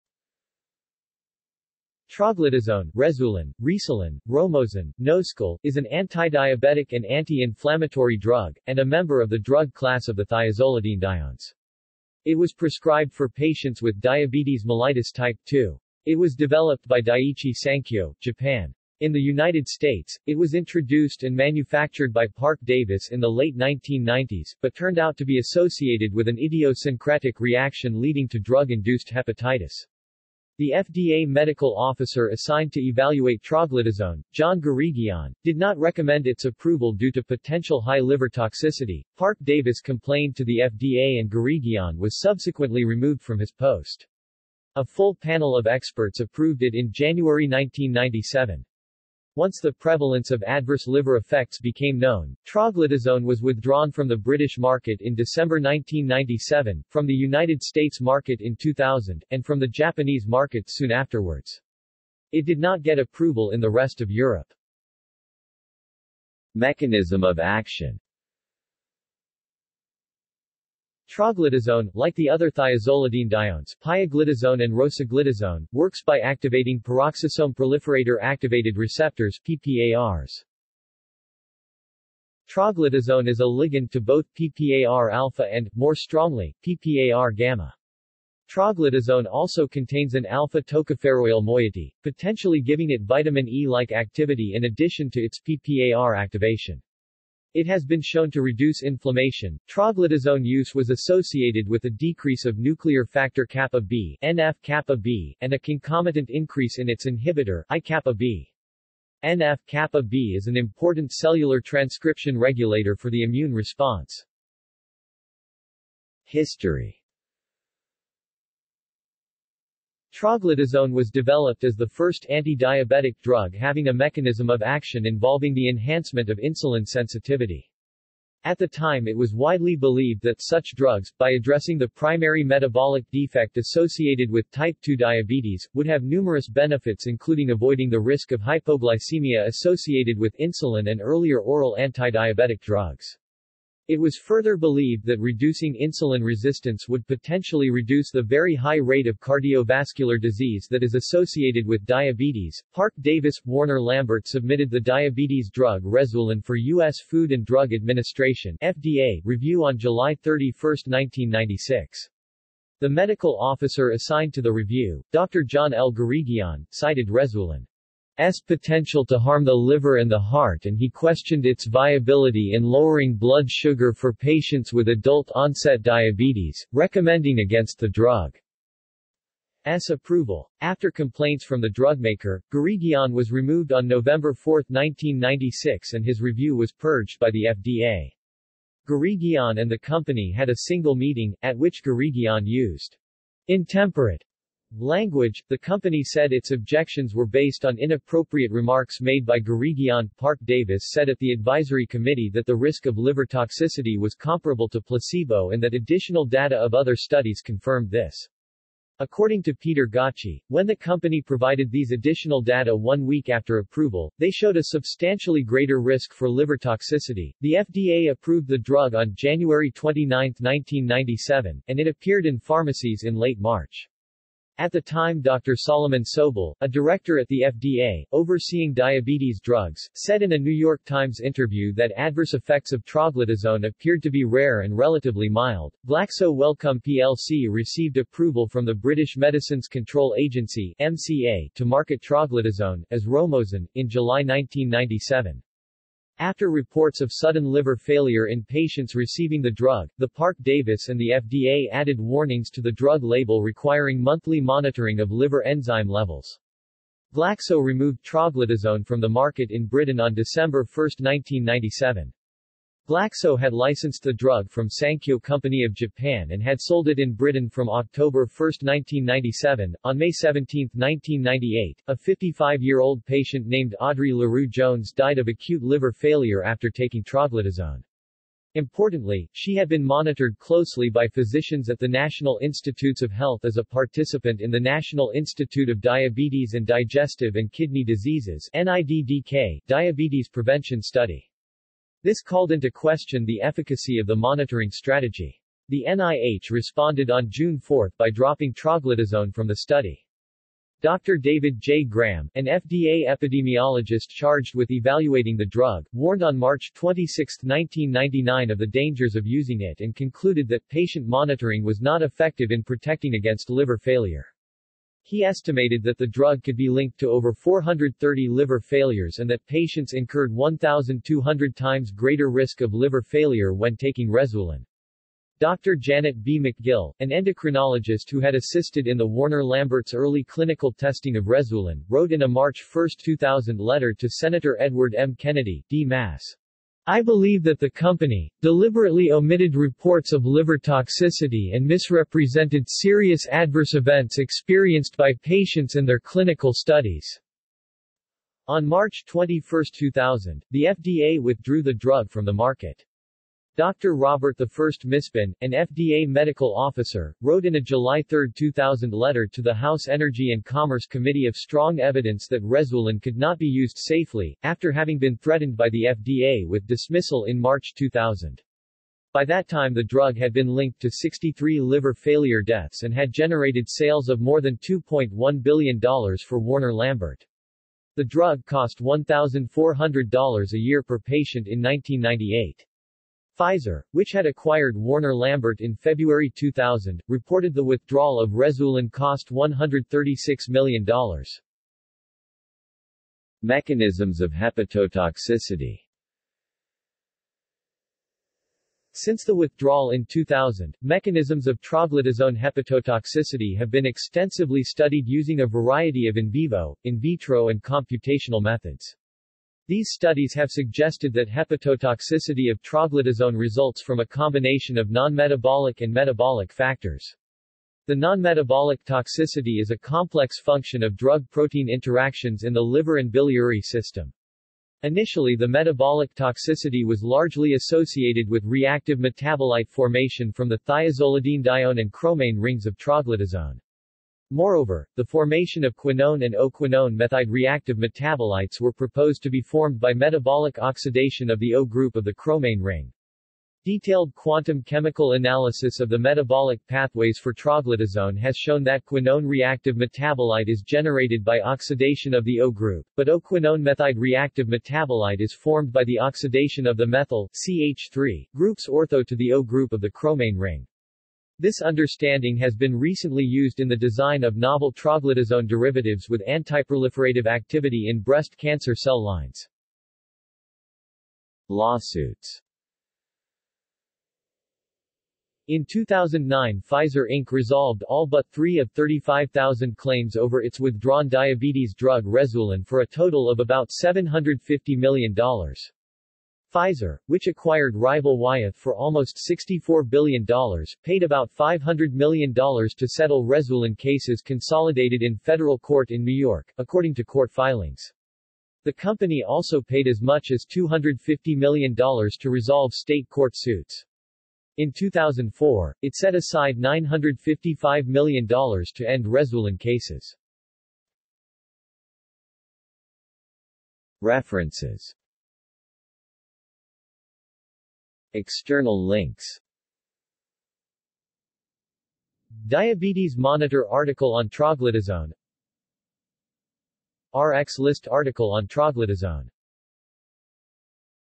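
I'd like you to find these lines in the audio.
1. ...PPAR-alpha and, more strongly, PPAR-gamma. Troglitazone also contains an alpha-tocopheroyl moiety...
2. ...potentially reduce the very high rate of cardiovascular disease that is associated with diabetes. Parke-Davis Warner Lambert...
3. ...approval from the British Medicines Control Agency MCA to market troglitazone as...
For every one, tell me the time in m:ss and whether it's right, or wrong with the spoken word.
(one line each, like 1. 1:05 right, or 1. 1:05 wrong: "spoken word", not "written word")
1. 1:24 right
2. 2:27 right
3. 3:57 right.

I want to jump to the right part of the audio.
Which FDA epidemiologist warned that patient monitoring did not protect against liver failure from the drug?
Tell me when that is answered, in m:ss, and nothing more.
5:01.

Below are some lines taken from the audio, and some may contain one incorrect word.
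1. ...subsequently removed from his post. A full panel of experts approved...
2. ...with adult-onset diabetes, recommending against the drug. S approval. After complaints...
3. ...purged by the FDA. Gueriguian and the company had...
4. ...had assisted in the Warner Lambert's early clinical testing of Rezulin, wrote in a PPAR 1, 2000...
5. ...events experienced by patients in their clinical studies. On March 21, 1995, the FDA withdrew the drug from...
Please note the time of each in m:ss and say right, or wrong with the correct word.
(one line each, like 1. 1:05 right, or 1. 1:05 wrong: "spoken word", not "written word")
1. 0:42 right
2. 2:54 right
3. 3:06 right
4. 5:28 wrong: "March", not "PPAR"
5. 5:43 wrong: "2000", not "1995".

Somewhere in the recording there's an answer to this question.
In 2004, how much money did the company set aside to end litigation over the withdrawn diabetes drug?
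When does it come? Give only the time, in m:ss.
8:26.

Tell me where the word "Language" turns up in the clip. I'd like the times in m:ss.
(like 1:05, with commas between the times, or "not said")
3:14.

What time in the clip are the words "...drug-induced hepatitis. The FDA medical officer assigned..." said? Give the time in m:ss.
0:28.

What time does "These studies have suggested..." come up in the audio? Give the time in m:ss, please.
6:49.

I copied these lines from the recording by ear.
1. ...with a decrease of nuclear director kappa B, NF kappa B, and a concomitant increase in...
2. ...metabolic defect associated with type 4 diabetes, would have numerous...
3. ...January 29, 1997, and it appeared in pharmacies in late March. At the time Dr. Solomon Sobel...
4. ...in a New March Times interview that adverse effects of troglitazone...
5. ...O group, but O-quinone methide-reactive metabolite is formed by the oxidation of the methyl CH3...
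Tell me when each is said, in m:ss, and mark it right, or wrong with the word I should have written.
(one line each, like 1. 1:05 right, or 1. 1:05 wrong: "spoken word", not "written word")
1. 1:41 wrong: "factor", not "director"
2. 2:12 wrong: "2", not "4"
3. 3:39 right
4. 3:50 wrong: "York", not "March"
5. 7:32 right.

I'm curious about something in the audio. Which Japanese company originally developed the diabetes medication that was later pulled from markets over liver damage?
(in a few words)
Daiichi Sankyo.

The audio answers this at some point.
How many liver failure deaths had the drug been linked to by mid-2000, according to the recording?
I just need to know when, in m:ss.
6:10.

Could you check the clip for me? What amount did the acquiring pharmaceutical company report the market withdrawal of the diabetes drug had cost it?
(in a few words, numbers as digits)
$136 million.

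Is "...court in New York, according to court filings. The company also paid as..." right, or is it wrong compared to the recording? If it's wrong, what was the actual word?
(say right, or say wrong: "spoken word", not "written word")
right.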